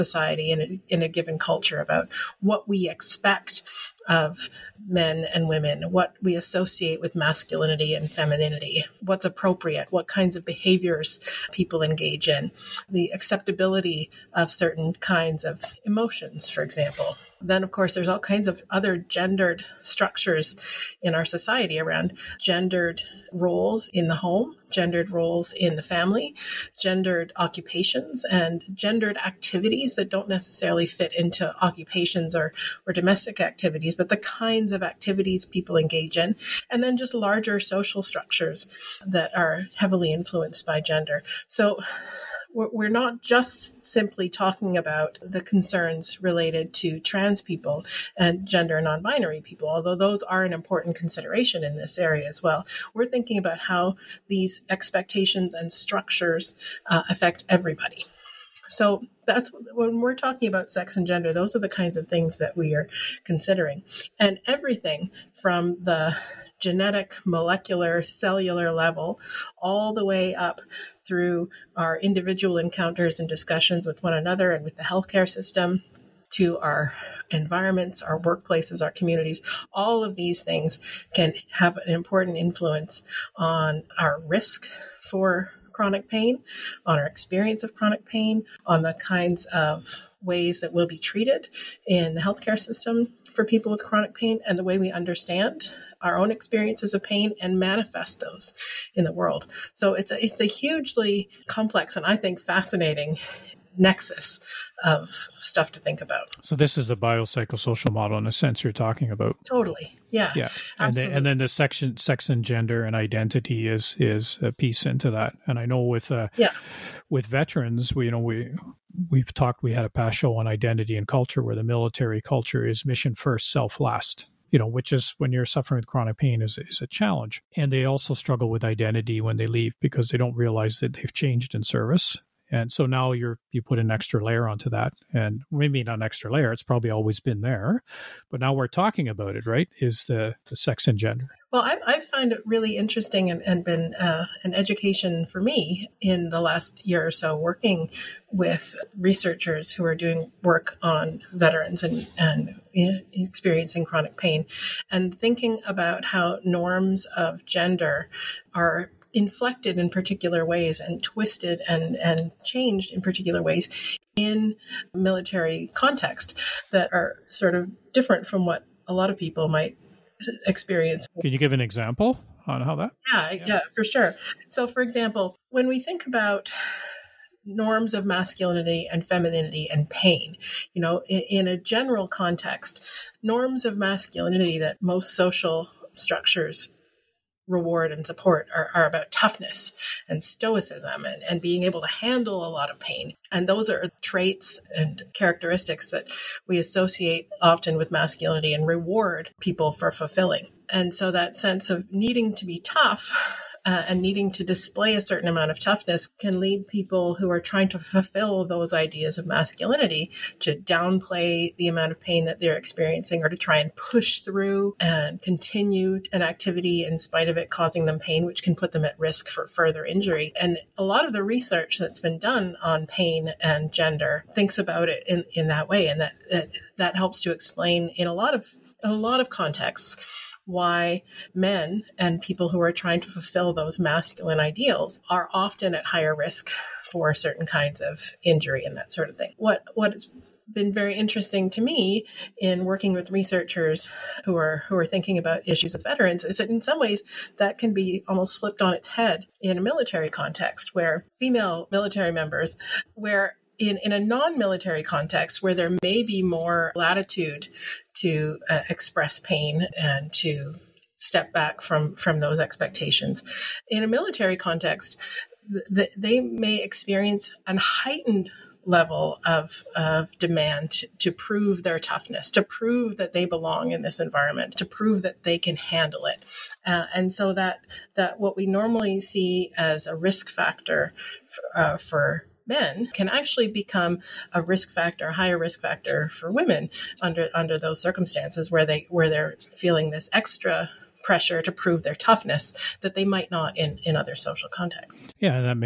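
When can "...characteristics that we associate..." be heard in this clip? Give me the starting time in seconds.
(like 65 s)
195 s.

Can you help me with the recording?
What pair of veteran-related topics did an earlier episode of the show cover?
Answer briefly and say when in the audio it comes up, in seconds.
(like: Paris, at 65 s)
Identity and culture, at 120 s.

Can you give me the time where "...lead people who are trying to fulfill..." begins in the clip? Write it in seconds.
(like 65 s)
206 s.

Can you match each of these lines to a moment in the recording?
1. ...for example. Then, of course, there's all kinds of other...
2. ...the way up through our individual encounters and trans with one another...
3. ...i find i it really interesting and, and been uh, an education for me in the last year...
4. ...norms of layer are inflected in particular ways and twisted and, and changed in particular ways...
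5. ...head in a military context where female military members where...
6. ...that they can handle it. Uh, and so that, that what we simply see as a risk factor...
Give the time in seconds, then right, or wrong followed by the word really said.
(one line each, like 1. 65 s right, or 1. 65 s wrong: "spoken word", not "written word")
1. 16 s right
2. 69 s wrong: "discussions", not "trans"
3. 141 s right
4. 156 s wrong: "gender", not "layer"
5. 248 s right
6. 275 s wrong: "normally", not "simply".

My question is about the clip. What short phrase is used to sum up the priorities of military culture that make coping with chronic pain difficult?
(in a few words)
Mission first, self last.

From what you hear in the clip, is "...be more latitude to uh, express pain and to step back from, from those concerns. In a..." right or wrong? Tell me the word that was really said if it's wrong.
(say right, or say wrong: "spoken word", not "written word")
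wrong: "expectations", not "concerns".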